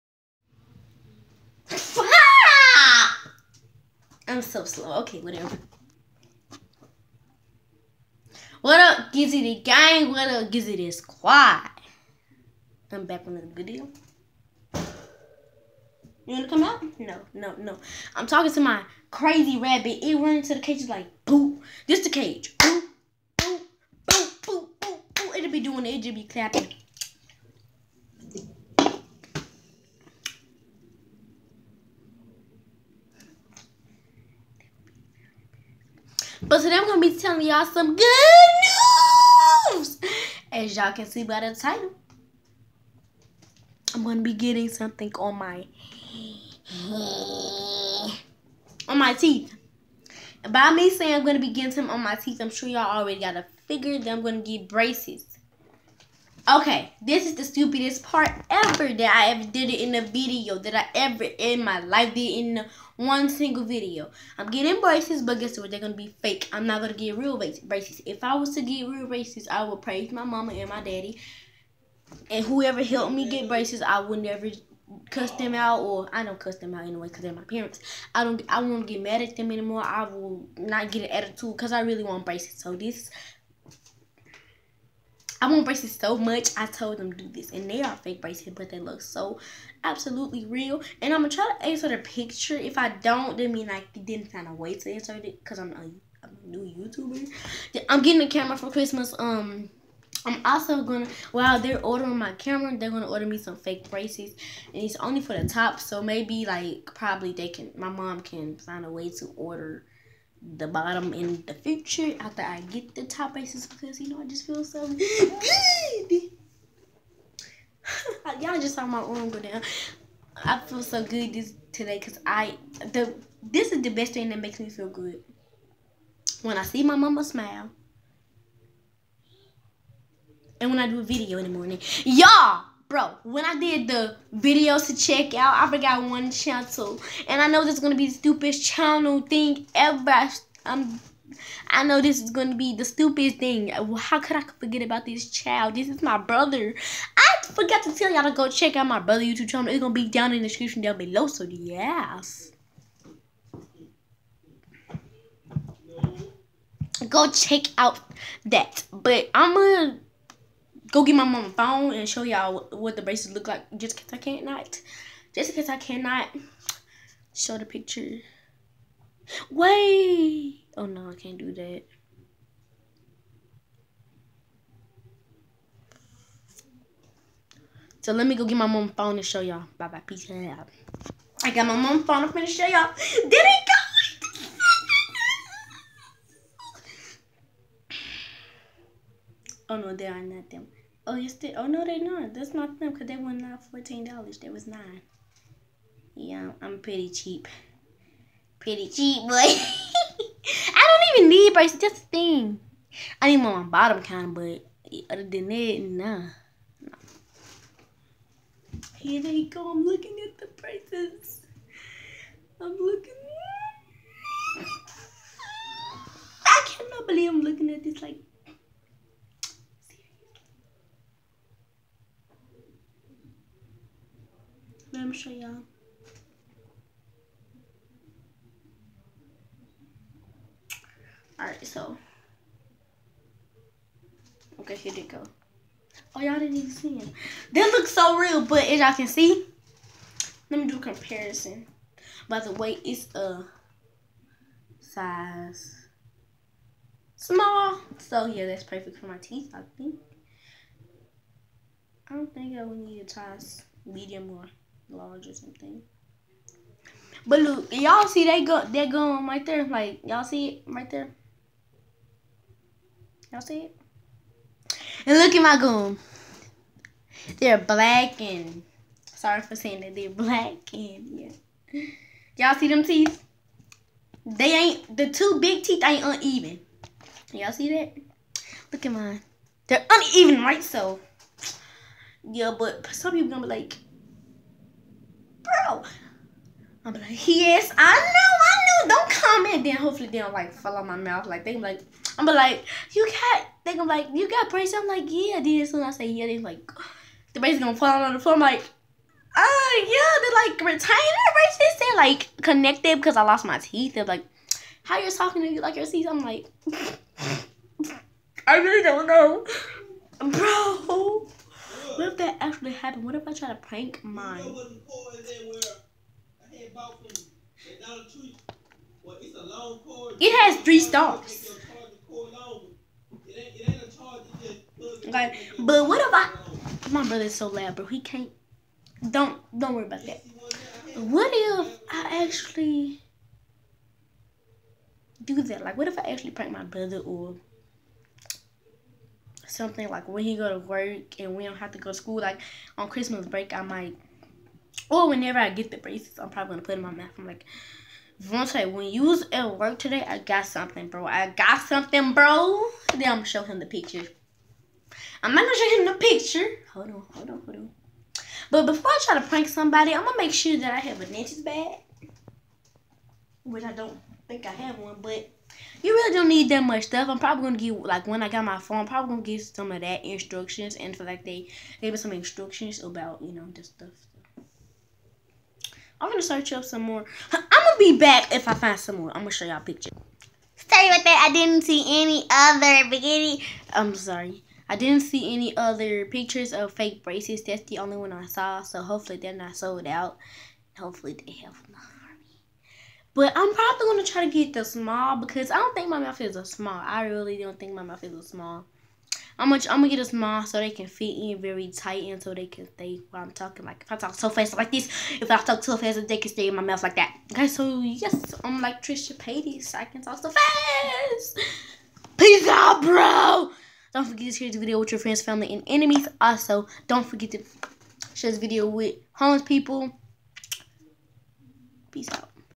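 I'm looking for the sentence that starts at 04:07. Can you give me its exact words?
So yeah, that's perfect for my teeth, I think.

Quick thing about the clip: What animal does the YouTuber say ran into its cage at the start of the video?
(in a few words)
Rabbit.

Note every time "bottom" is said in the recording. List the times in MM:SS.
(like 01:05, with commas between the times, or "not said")
01:50, 03:23.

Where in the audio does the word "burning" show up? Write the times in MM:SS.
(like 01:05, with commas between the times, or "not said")
not said.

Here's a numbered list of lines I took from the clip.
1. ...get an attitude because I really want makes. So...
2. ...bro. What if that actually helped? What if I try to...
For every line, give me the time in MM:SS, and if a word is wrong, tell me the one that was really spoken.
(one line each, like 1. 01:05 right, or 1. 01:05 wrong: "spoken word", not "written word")
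1. 01:20 wrong: "braces", not "makes"
2. 05:10 wrong: "happened", not "helped".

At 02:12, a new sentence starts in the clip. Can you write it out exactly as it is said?
Y'all Bro, when I did the videos to check out, I forgot one channel.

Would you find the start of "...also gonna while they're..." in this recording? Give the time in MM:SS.
01:40.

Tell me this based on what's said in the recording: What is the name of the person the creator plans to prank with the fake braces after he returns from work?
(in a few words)
Vontae.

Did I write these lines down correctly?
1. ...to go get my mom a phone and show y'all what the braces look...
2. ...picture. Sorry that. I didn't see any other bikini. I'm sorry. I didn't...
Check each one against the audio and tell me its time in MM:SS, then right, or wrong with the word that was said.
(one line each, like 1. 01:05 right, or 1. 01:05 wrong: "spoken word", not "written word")
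1. 02:39 right
2. 06:19 right.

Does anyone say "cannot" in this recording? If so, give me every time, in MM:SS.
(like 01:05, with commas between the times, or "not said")
02:45, 03:36.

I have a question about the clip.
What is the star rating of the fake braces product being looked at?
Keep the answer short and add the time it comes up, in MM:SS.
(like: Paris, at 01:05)
3 stars, at 05:20.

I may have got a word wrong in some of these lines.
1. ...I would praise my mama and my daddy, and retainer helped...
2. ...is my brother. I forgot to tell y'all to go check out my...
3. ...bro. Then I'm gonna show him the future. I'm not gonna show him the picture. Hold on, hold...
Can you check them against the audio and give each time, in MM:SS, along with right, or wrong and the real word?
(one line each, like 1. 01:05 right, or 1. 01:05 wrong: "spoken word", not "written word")
1. 01:09 wrong: "whoever", not "retainer"
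2. 02:25 right
3. 05:52 wrong: "picture", not "future".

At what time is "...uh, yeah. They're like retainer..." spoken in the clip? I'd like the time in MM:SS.
04:59.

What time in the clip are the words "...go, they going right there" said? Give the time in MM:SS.
04:18.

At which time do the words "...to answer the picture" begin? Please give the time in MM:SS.
01:31.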